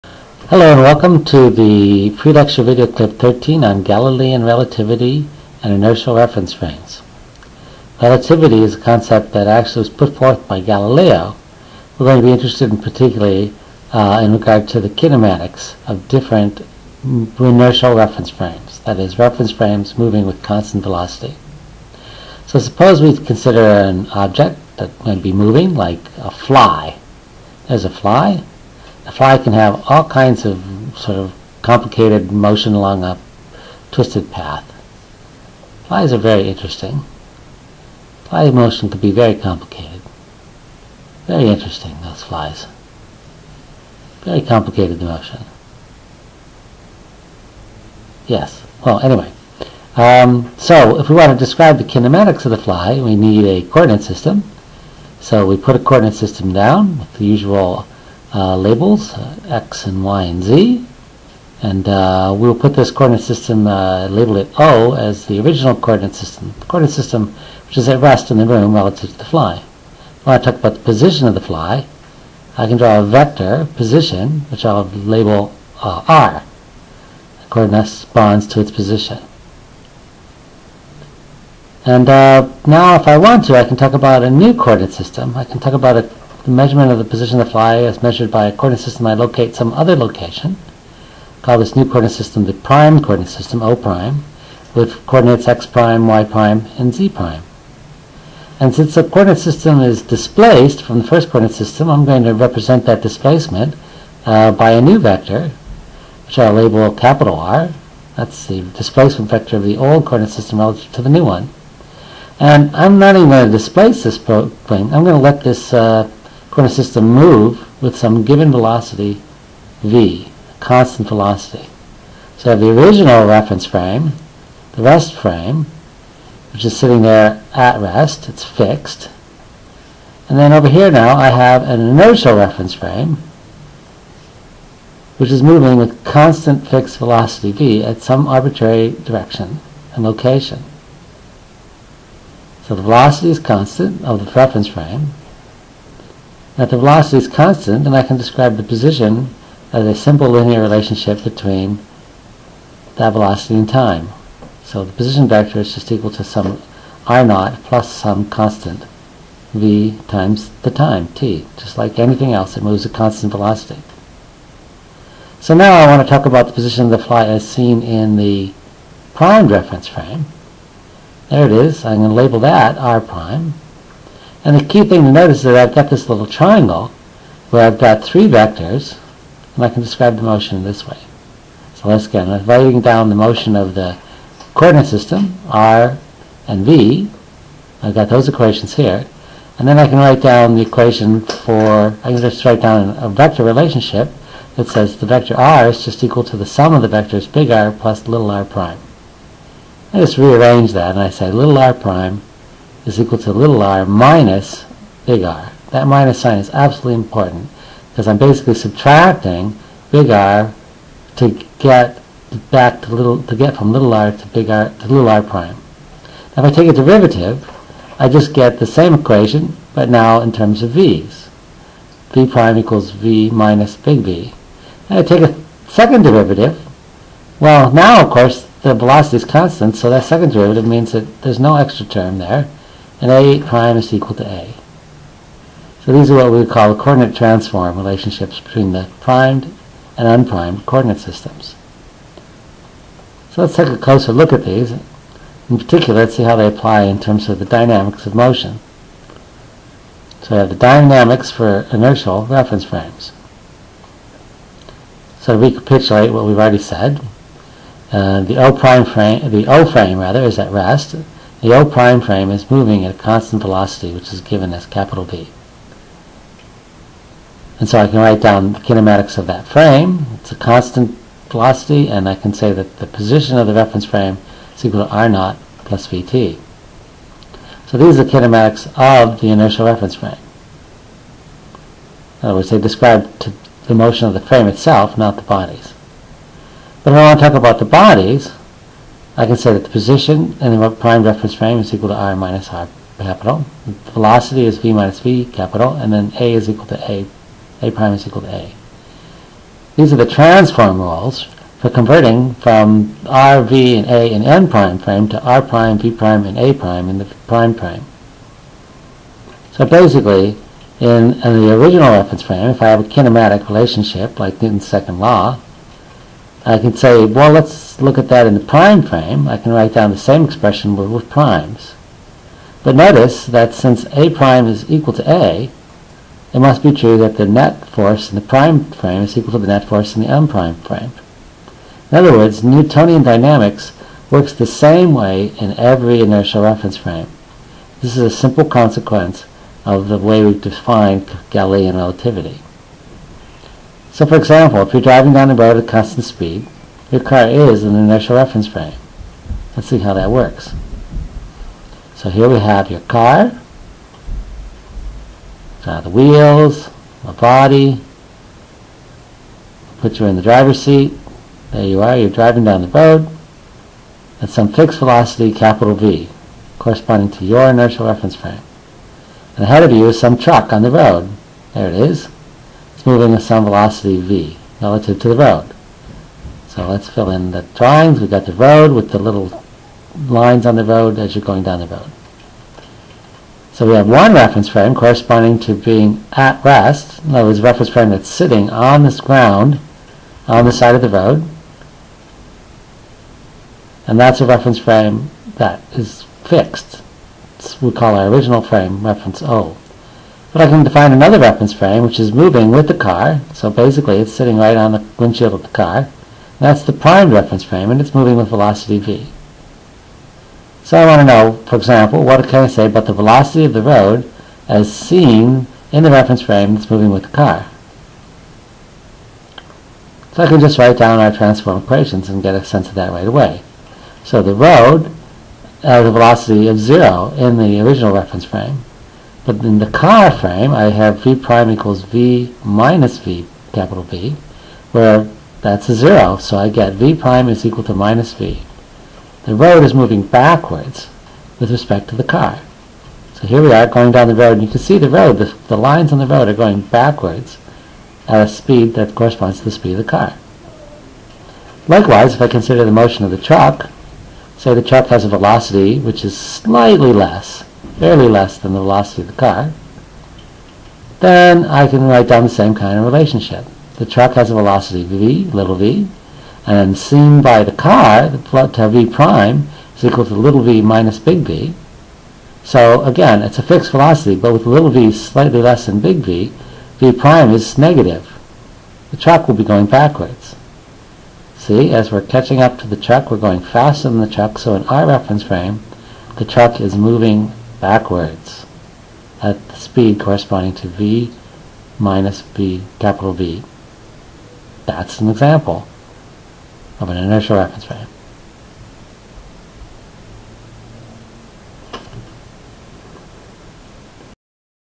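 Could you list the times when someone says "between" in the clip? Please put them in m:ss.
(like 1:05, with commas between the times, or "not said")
2:31, 3:58.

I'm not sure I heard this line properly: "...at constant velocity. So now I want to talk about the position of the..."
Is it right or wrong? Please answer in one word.
right.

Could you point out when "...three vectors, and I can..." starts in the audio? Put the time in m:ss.
2:58.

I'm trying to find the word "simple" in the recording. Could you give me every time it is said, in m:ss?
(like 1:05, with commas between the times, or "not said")
2:29, 5:38.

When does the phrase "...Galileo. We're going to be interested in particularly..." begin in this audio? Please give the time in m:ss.
0:10.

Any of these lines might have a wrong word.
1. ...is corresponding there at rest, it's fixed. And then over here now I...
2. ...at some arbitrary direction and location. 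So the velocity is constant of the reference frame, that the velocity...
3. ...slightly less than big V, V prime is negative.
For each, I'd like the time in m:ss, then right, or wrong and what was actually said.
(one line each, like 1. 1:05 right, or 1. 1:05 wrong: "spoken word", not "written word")
1. 2:06 wrong: "sitting", not "corresponding"
2. 2:17 right
3. 7:54 right.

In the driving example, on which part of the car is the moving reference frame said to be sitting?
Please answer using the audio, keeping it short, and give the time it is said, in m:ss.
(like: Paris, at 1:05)
the windshield, at 6:44.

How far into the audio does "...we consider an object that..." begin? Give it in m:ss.
0:23.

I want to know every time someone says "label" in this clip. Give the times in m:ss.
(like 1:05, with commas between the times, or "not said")
0:58, 1:04, 1:14, 1:46, 2:52.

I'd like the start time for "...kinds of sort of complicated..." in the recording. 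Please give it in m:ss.
0:30.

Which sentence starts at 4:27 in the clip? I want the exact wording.
And so I can write down the kinematics of that frame.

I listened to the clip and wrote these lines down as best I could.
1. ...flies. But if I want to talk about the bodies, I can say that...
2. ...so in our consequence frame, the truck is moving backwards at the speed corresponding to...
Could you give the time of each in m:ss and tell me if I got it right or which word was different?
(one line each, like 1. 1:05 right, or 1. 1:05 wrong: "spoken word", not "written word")
1. 4:45 wrong: "bodies", not "flies"
2. 8:04 wrong: "reference", not "consequence".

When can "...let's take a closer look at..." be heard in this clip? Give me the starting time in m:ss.
4:03.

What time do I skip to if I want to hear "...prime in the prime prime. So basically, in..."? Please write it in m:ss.
5:06.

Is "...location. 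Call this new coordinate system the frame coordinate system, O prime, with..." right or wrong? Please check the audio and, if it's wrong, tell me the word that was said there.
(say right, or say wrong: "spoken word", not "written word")
wrong: "prime", not "frame".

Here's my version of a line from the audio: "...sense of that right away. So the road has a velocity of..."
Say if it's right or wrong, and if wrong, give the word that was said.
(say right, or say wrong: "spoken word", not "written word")
right.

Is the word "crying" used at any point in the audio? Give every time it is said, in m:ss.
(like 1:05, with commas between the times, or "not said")
not said.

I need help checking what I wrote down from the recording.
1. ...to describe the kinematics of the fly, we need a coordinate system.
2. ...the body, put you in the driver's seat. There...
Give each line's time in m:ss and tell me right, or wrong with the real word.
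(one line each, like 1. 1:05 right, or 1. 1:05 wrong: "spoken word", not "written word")
1. 0:51 right
2. 5:57 right.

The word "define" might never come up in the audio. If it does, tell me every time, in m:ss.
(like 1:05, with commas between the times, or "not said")
5:40, 6:40.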